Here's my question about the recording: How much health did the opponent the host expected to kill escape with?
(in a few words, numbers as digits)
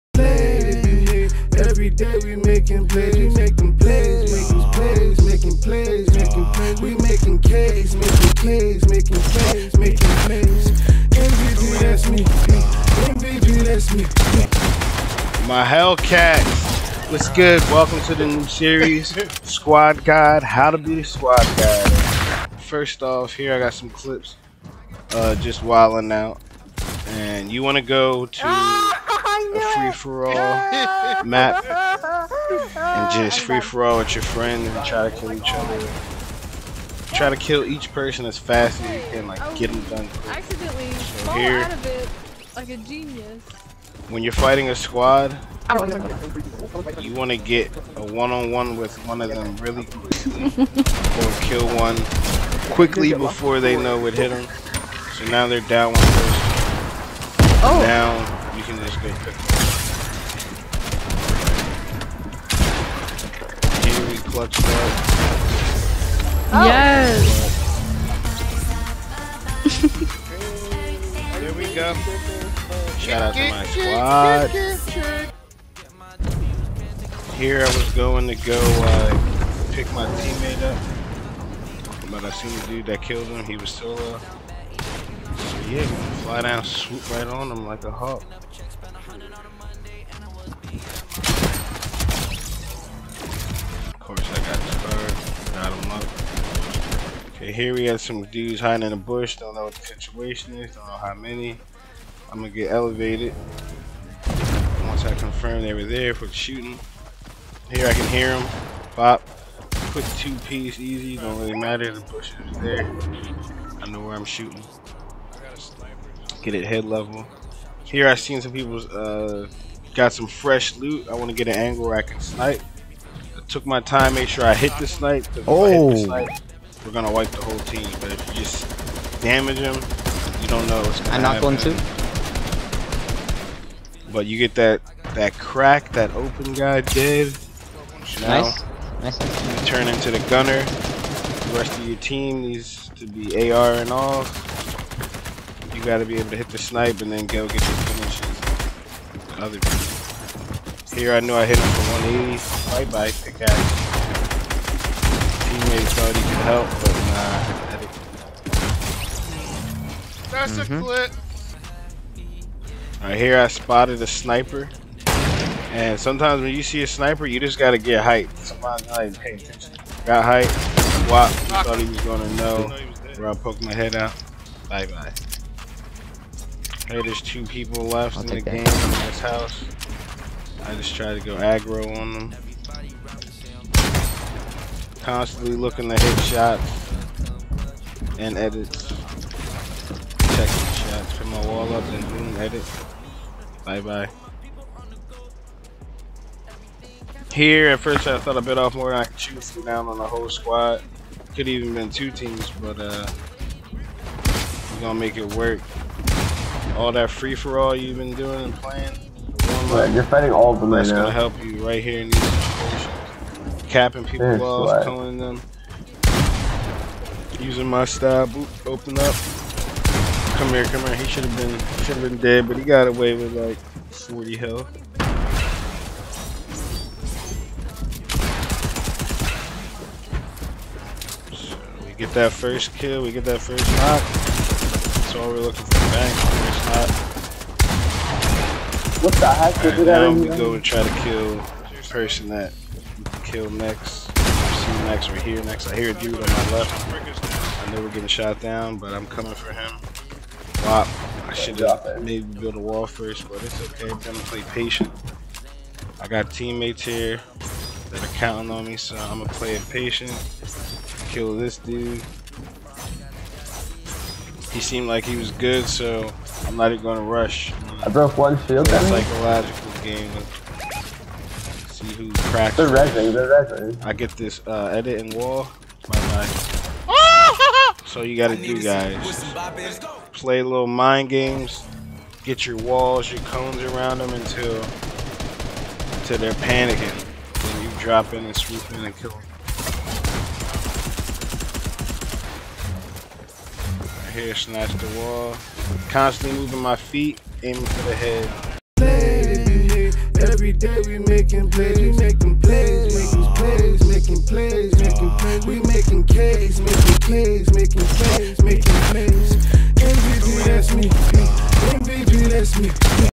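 40.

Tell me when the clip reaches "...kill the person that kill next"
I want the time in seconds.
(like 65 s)
241 s.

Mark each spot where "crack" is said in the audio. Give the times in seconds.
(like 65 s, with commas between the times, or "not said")
135 s, 272 s.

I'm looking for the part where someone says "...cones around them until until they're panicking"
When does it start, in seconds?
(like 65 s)
283 s.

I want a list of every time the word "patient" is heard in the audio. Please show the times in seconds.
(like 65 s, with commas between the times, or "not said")
254 s, 259 s.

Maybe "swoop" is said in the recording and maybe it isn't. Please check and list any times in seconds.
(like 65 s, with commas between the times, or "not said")
86 s, 288 s.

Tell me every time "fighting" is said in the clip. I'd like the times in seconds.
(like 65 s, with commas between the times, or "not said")
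44 s, 210 s.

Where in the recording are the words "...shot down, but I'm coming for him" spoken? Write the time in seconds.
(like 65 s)
248 s.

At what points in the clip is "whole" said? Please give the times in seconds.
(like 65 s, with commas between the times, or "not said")
127 s, 200 s.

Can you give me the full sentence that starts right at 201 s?
Could even been two teams, but uh, we're gonna make it work.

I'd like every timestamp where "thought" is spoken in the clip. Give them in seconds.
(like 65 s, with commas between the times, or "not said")
155 s, 171 s, 198 s.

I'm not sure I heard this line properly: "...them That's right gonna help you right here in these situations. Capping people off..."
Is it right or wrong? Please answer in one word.
right.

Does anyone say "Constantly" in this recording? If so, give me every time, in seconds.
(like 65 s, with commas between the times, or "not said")
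185 s, 295 s.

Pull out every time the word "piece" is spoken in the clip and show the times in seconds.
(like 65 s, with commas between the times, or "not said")
110 s.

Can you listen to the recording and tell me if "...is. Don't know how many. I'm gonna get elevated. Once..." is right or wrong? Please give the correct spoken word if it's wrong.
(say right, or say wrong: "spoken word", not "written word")
right.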